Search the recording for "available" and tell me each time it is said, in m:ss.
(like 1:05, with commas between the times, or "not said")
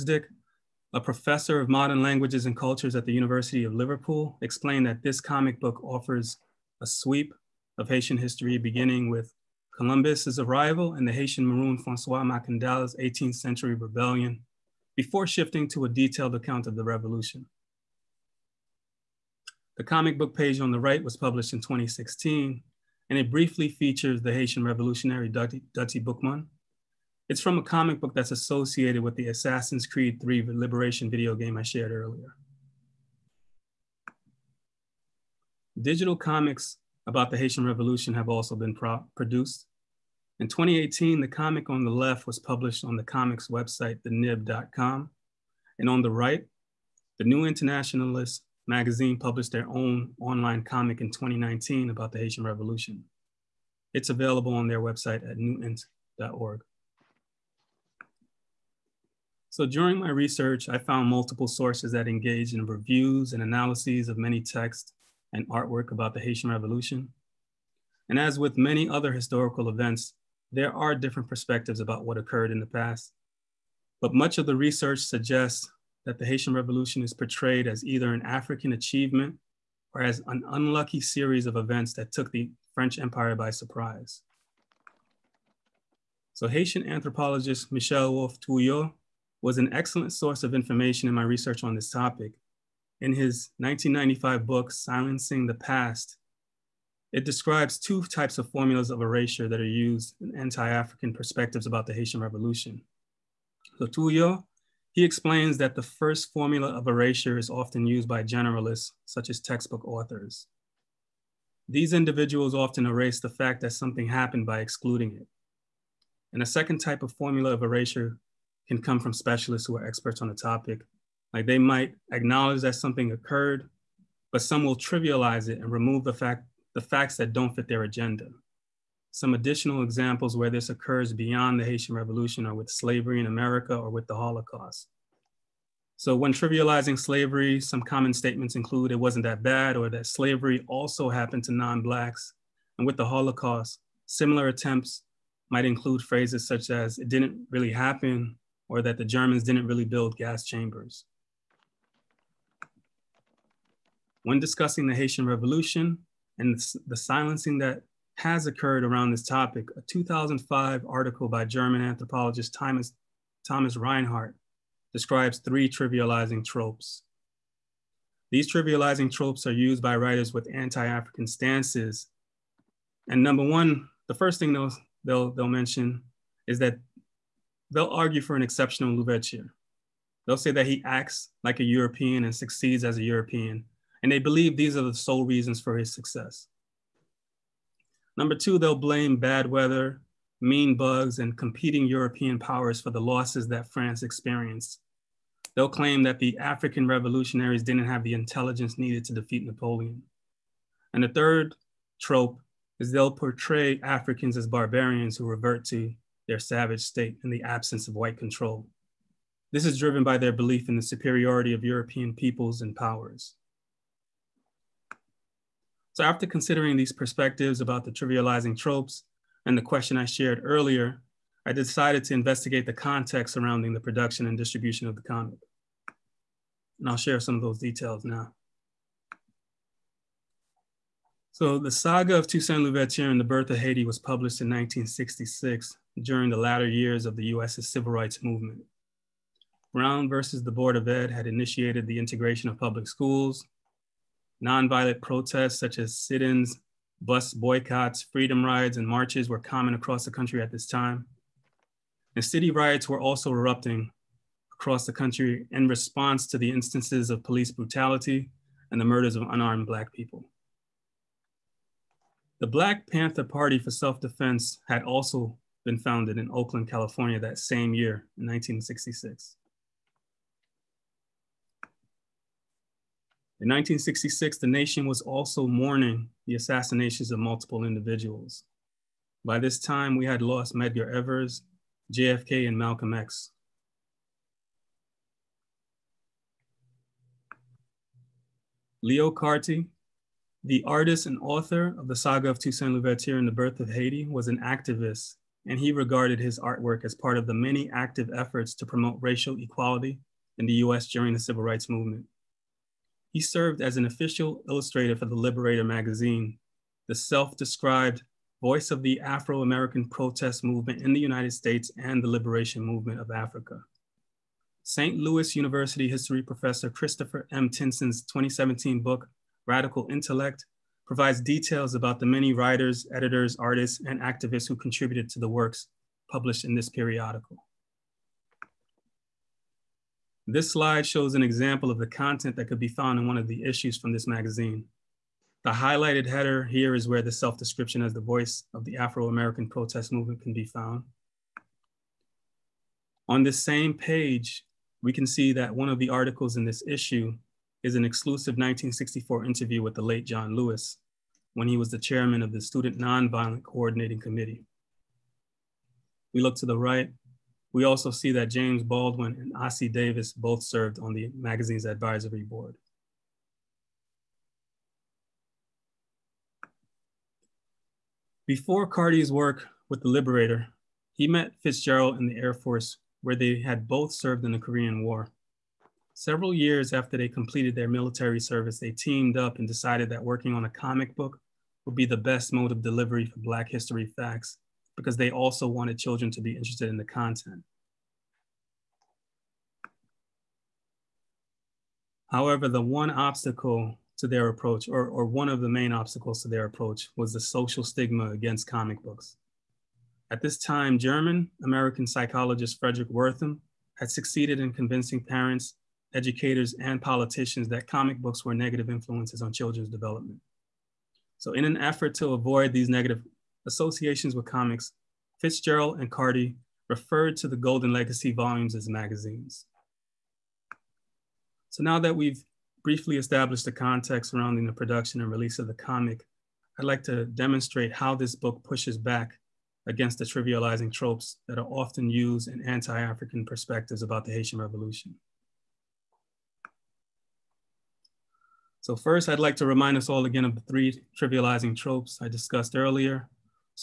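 0:54.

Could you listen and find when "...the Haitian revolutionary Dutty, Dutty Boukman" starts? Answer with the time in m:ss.
0:24.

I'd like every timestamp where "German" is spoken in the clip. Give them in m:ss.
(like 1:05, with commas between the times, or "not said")
2:29, 2:41, 6:40.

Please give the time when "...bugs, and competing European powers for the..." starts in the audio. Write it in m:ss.
3:10.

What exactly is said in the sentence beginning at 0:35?
Digital comics about the Haitian Revolution have also been produced.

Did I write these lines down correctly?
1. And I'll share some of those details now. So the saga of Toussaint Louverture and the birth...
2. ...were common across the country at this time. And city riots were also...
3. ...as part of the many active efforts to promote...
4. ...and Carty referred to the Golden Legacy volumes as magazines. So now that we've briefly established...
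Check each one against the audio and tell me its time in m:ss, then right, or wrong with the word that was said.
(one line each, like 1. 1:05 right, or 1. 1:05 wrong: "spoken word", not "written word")
1. 3:46 right
2. 4:09 right
3. 4:56 right
4. 6:55 right.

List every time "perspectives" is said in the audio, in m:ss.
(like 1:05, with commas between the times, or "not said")
1:11, 1:41, 3:36, 7:13.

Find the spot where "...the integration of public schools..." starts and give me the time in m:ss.
4:01.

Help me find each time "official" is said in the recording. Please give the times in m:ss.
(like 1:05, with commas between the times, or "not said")
5:03.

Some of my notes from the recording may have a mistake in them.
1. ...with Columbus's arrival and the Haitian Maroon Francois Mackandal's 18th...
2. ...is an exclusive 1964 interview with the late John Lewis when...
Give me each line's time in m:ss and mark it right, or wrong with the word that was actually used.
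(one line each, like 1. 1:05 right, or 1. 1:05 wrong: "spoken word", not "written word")
1. 0:09 right
2. 5:47 right.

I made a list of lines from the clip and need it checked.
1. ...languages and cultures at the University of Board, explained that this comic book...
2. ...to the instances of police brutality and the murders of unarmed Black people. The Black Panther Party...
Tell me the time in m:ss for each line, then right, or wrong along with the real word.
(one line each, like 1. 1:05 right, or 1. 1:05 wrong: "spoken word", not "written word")
1. 0:02 wrong: "Liverpool", not "Board"
2. 4:16 right.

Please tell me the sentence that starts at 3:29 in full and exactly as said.
This is driven by their belief in the superiority of European peoples and powers.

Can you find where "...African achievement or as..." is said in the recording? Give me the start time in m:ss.
1:18.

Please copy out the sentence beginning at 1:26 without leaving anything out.
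So Haitian anthropologist Michel Rolph Trouillot was an excellent source of information in my research on this topic.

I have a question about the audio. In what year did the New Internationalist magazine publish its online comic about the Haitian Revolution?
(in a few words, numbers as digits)
2019.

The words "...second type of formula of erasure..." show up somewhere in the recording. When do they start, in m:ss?
1:56.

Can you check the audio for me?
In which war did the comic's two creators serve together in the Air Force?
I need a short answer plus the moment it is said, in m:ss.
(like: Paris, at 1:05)
Korean War, at 6:14.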